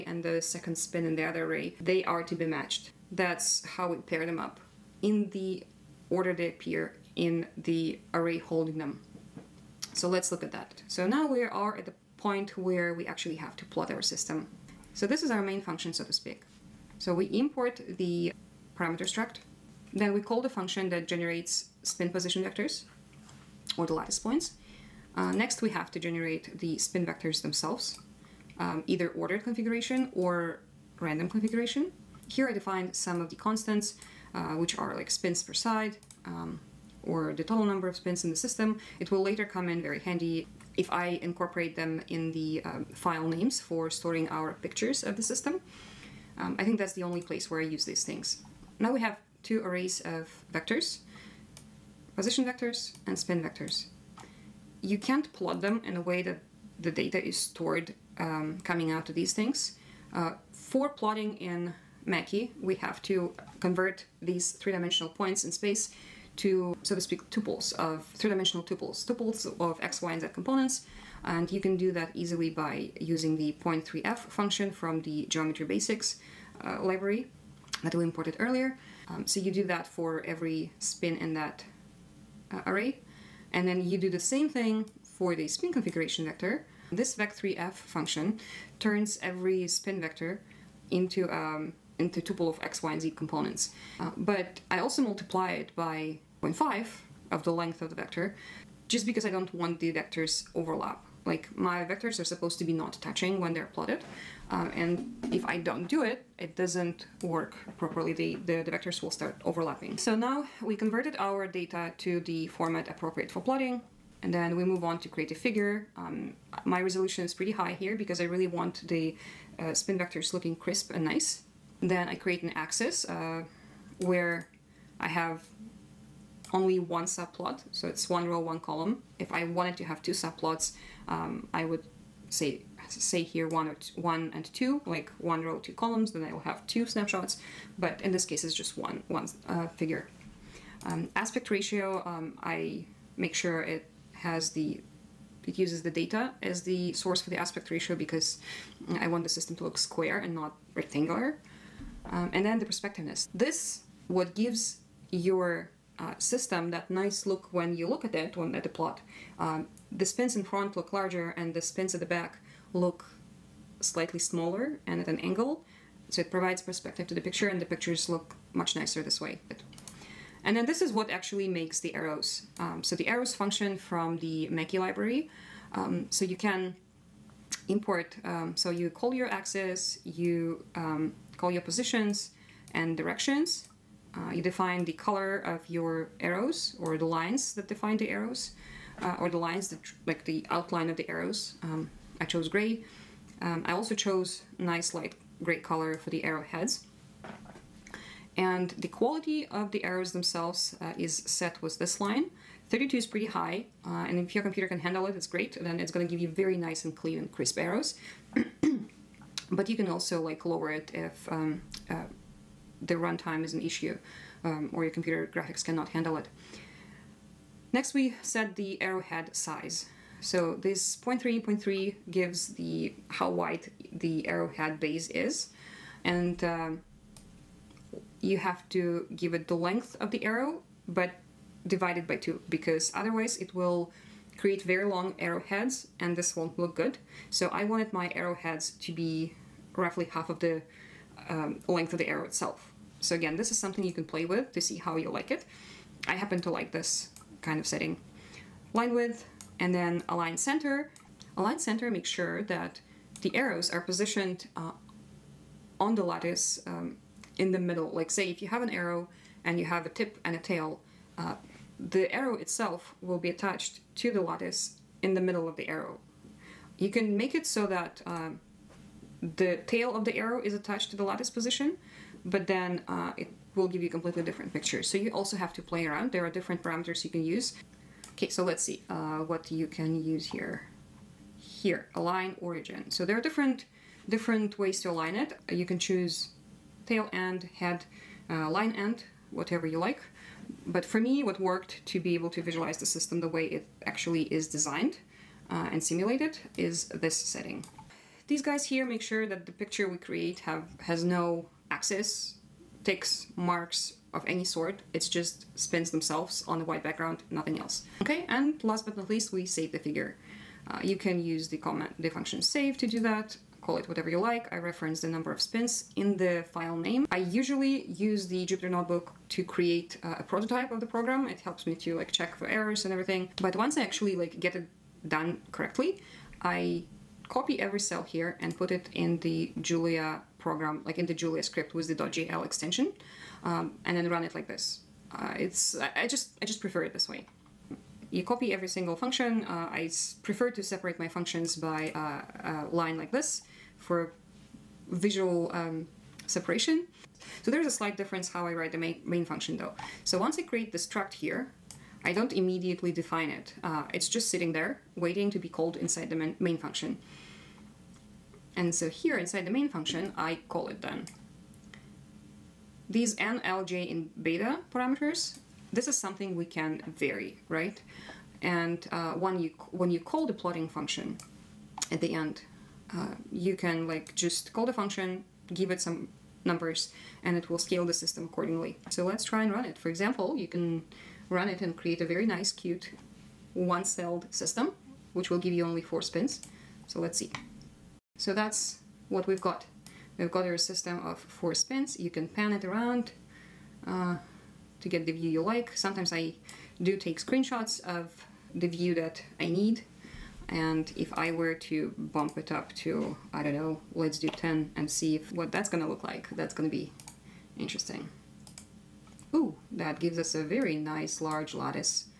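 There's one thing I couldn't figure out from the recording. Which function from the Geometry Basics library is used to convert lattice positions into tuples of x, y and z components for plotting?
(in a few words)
Point3f.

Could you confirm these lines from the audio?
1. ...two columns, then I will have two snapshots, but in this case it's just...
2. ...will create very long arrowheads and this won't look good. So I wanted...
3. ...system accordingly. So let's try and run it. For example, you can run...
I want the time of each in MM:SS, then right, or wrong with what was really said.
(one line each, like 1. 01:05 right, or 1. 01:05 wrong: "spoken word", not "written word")
1. 02:15 right
2. 03:53 right
3. 06:17 right.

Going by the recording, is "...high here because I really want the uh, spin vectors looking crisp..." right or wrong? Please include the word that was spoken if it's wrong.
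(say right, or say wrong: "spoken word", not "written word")
right.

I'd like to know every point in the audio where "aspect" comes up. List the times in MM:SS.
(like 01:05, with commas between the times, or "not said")
02:21, 02:27.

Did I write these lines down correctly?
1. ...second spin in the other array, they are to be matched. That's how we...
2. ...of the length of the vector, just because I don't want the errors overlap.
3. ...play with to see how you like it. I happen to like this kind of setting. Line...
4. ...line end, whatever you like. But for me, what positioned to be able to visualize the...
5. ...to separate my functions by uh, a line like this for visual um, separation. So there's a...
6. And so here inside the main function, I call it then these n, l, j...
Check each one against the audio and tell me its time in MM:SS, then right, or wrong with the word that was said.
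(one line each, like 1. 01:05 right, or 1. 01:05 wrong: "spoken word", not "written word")
1. 00:00 right
2. 01:37 wrong: "vectors", not "errors"
3. 04:04 right
4. 04:48 wrong: "worked", not "positioned"
5. 05:40 right
6. 05:58 right.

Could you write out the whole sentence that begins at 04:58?
These guys here make sure that the picture we create have has no axis, ticks, marks, of any sort.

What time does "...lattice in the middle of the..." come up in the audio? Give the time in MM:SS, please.
04:24.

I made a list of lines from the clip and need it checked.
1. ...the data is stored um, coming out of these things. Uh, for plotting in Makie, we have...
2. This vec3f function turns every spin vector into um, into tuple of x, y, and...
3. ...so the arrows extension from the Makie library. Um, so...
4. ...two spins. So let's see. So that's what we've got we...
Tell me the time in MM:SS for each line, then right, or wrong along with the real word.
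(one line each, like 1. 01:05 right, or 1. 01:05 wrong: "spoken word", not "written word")
1. 00:56 right
2. 01:26 right
3. 02:52 wrong: "function", not "extension"
4. 06:25 wrong: "four", not "two".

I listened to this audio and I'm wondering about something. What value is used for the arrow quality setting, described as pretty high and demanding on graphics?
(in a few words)
32.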